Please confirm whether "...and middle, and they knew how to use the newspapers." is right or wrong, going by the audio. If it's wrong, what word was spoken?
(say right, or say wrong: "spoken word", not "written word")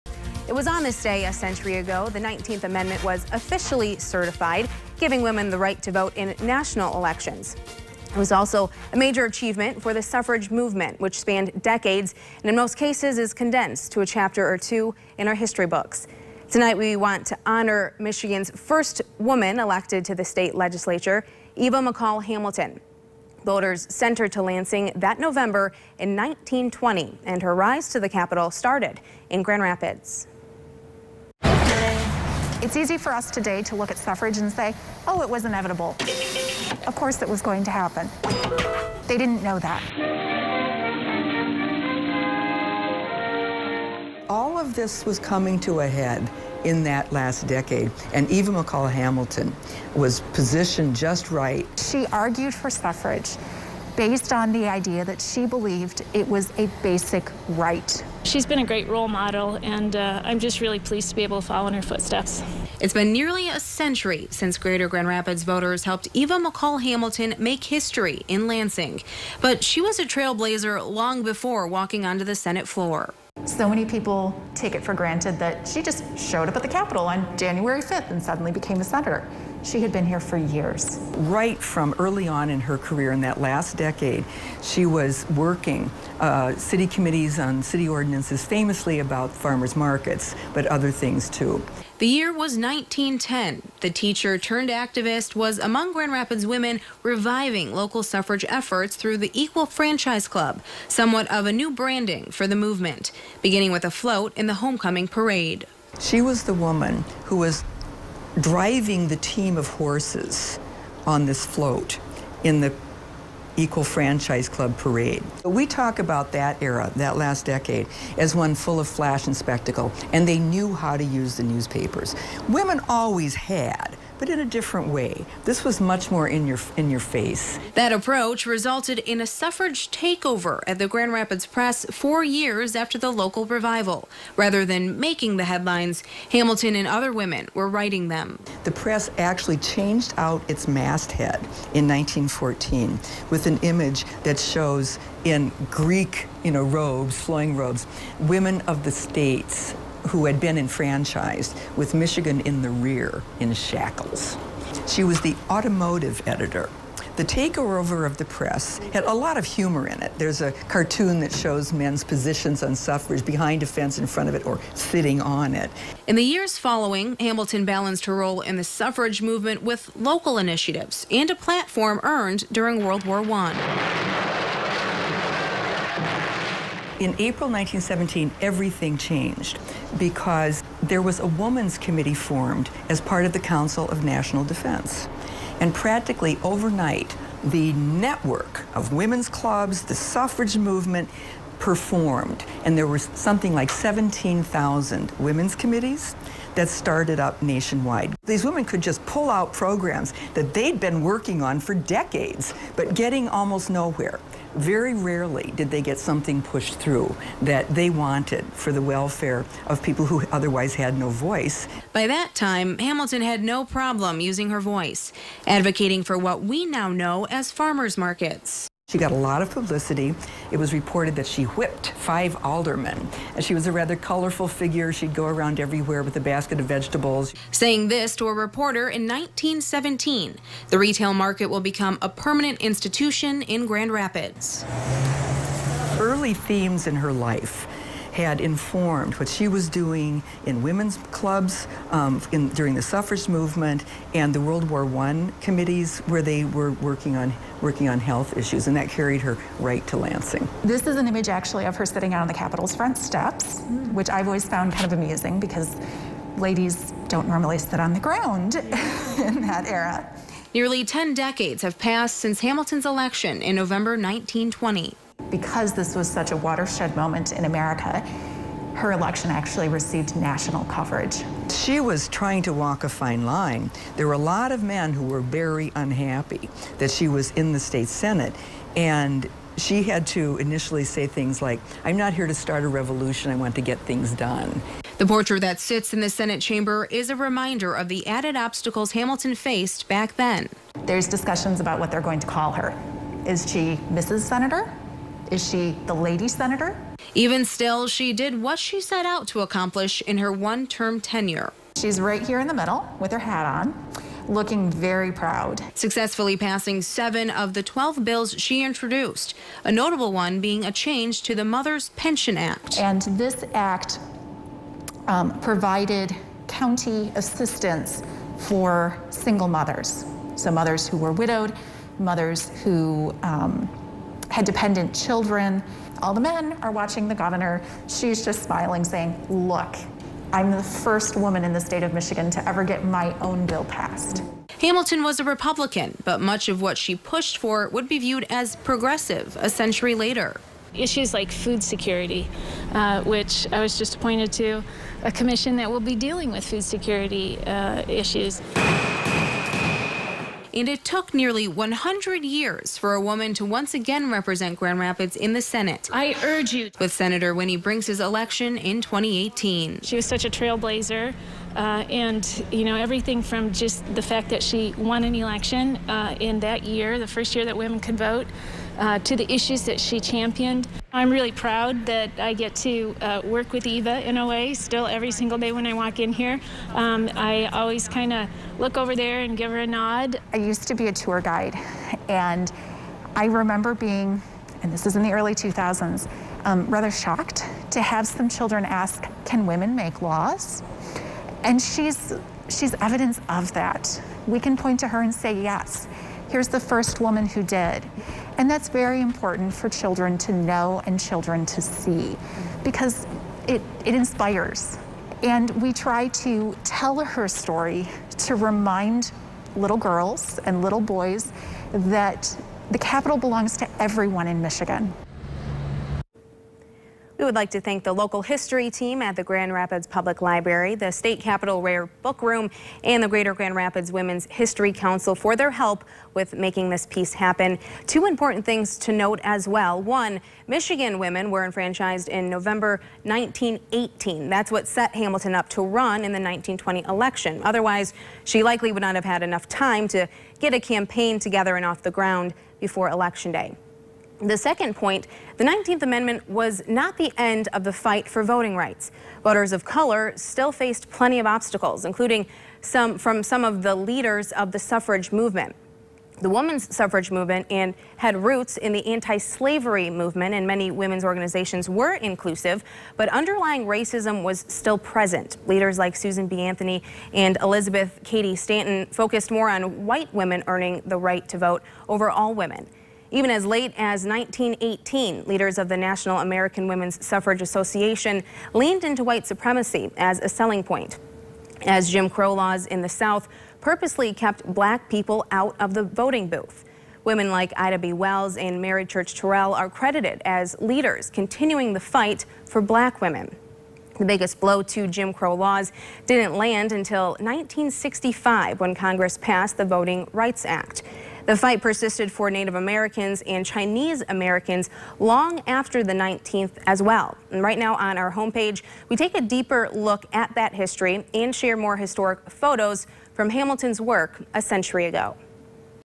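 wrong: "spectacle", not "middle".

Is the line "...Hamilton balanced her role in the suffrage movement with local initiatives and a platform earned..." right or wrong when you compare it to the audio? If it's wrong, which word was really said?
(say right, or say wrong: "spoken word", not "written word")
right.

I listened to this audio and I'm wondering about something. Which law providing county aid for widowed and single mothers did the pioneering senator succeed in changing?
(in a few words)
Mother's Pension Act.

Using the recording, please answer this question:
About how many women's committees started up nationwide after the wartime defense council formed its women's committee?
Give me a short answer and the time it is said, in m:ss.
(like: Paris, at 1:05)
17,000, at 3:13.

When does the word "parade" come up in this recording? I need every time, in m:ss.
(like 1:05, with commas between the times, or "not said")
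1:45, 1:54.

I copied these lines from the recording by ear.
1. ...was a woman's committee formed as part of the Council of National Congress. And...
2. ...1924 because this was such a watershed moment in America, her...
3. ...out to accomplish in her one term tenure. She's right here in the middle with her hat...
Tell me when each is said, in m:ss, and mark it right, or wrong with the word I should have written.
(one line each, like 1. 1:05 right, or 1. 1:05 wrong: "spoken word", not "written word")
1. 3:01 wrong: "Defense", not "Congress"
2. 4:23 wrong: "1920", not "1924"
3. 4:59 right.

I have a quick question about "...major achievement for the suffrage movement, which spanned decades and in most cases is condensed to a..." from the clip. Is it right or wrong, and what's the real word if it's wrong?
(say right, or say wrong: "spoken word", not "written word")
right.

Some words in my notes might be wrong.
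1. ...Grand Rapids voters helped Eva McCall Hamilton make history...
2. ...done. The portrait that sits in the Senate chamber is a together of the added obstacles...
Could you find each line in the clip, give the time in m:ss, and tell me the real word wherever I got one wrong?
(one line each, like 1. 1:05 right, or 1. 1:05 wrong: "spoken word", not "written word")
1. 1:04 right
2. 4:44 wrong: "reminder", not "together".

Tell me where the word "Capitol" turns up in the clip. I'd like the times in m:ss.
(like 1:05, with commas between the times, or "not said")
0:28, 1:16, 4:12, 6:52, 7:01.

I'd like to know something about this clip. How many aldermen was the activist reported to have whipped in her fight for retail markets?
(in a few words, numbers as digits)
five.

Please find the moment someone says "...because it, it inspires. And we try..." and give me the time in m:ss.
6:42.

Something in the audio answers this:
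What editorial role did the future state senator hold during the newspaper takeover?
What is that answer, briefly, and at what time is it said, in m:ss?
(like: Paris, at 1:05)
automotive editor, at 2:35.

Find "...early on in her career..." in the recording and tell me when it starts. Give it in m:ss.
1:21.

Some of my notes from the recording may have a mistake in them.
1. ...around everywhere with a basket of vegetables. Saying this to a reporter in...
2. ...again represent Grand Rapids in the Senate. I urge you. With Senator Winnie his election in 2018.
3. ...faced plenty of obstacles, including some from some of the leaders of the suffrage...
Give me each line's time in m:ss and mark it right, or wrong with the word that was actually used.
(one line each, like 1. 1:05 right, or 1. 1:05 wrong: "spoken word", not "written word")
1. 3:45 right
2. 5:53 right
3. 7:30 right.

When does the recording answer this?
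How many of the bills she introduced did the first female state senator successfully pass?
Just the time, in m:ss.
5:06.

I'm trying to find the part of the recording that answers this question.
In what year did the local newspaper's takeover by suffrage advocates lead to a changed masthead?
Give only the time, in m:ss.
2:21.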